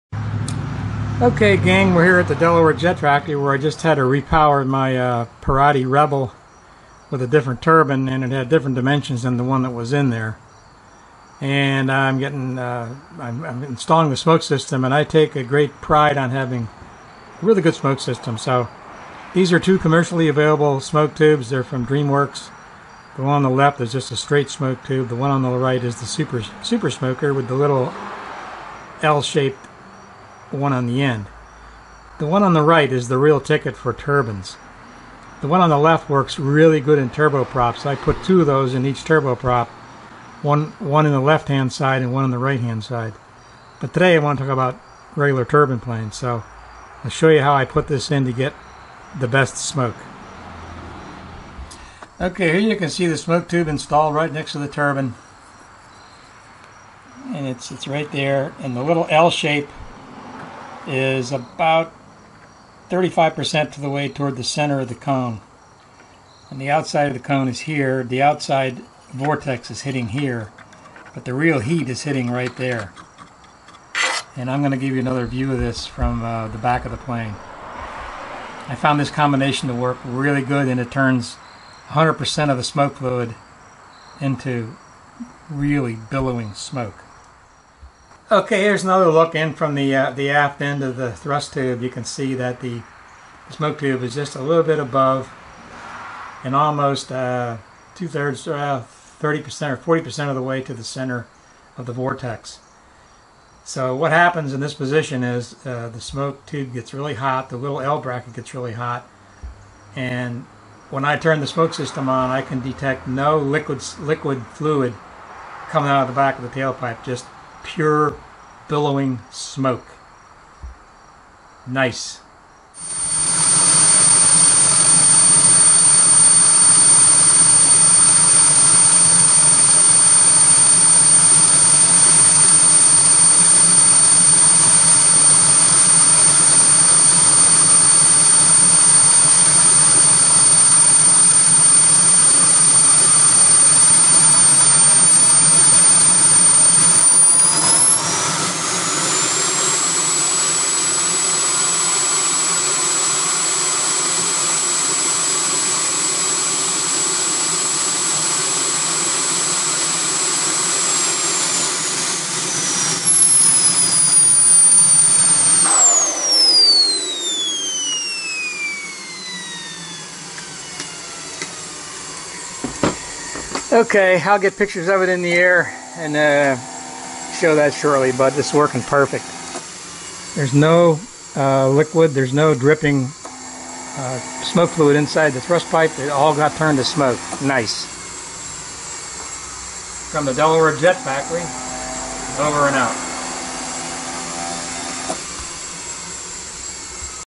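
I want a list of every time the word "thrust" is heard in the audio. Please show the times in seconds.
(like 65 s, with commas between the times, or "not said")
91 s, 185 s.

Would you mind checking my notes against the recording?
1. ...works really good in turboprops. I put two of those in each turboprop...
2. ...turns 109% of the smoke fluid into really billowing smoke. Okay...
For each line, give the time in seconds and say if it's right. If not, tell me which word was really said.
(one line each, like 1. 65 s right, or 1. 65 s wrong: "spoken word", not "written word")
1. 36 s right
2. 80 s wrong: "100", not "109".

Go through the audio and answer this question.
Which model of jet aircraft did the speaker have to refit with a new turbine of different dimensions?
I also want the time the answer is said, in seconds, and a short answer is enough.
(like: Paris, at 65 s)
Pirotti Rebel, at 5 s.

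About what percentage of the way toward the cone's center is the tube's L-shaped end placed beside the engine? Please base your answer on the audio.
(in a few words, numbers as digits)
35%.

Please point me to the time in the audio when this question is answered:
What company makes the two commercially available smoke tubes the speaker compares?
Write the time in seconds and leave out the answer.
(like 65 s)
21 s.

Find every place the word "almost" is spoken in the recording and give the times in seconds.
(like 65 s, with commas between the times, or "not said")
96 s.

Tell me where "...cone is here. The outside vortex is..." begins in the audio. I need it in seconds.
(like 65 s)
67 s.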